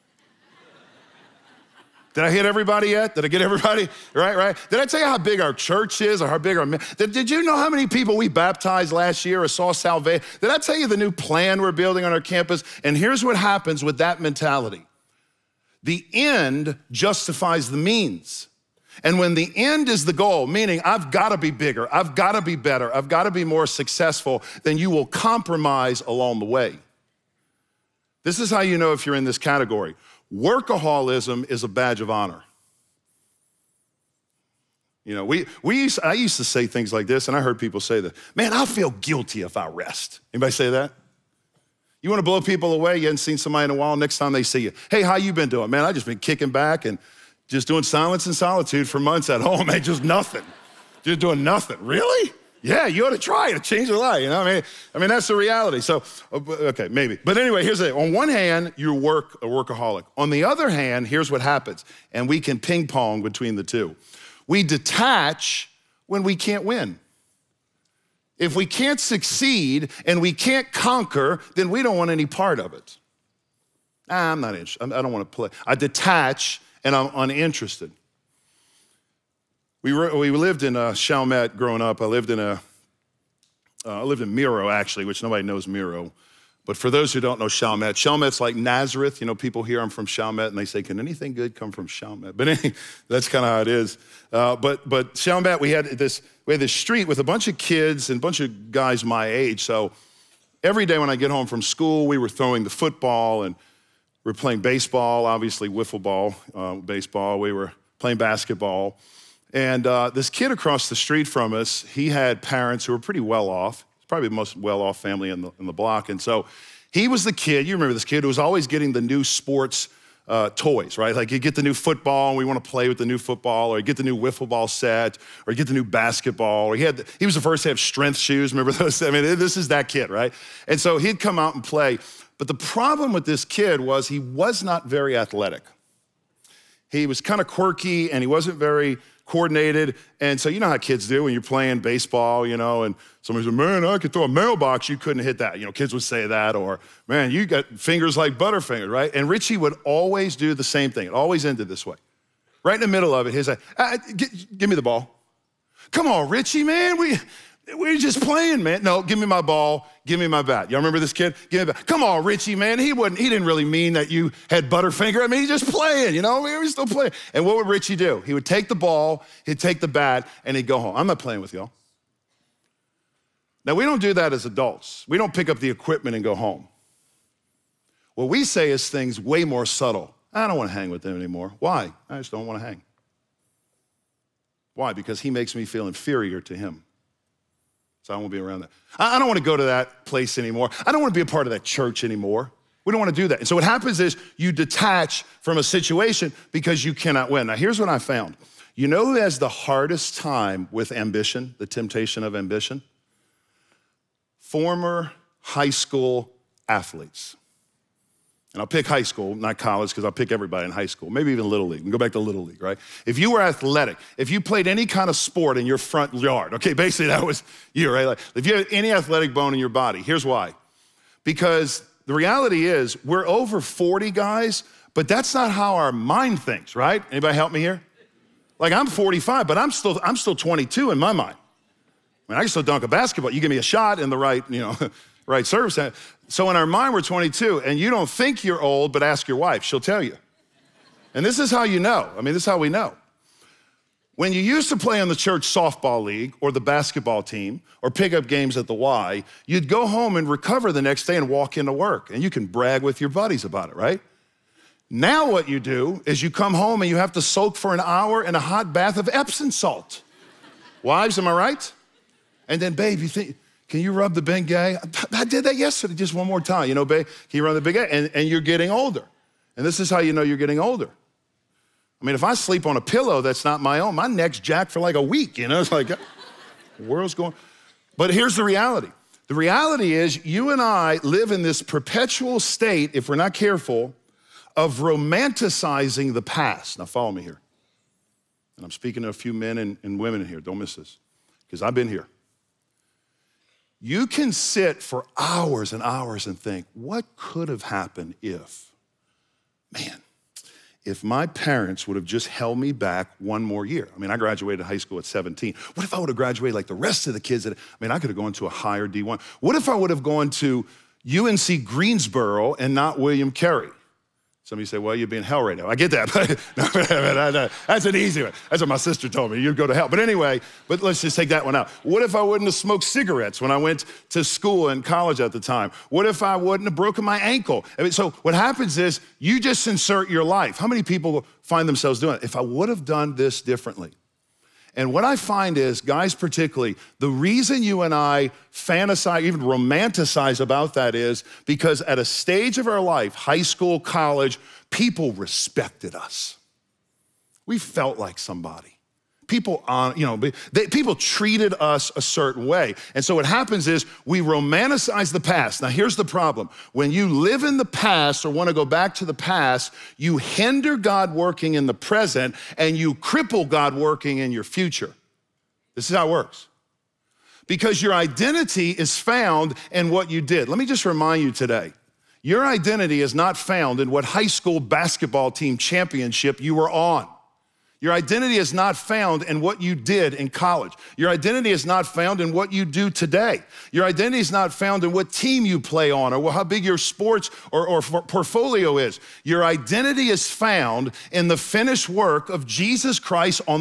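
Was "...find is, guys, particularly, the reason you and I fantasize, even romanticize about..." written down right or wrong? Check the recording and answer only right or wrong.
right.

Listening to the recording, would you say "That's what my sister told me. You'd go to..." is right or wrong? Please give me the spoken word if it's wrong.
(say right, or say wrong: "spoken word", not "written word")
right.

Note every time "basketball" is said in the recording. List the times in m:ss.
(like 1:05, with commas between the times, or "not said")
1:48, 2:05, 3:52, 4:06, 6:14.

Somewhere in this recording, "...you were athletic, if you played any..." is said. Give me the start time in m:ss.
3:33.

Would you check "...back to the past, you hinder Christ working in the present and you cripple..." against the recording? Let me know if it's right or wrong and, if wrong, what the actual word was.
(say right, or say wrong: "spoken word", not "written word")
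wrong: "God", not "Christ".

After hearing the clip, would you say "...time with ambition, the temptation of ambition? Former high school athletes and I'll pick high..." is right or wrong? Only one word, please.
right.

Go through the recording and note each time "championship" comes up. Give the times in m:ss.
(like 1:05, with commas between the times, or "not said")
6:15.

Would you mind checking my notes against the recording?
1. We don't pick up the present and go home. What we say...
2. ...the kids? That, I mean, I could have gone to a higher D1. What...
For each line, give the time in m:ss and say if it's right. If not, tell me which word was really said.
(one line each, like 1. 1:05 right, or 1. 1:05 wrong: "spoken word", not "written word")
1. 2:55 wrong: "equipment", not "present"
2. 5:07 right.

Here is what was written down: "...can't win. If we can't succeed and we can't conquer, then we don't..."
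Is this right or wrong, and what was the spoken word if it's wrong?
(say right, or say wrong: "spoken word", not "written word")
right.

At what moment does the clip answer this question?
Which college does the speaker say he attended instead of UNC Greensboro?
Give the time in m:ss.
5:12.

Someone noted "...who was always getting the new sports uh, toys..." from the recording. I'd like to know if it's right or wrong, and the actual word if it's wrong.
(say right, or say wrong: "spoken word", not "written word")
right.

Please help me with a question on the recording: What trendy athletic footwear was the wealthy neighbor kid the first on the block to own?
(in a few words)
strength shoes.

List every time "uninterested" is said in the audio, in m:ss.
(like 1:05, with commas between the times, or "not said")
1:17.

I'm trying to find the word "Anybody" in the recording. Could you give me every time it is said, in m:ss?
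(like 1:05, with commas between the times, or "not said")
0:40, 3:47.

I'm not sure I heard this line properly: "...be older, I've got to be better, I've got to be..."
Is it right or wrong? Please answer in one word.
wrong.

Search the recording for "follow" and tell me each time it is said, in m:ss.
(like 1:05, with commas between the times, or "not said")
4:46.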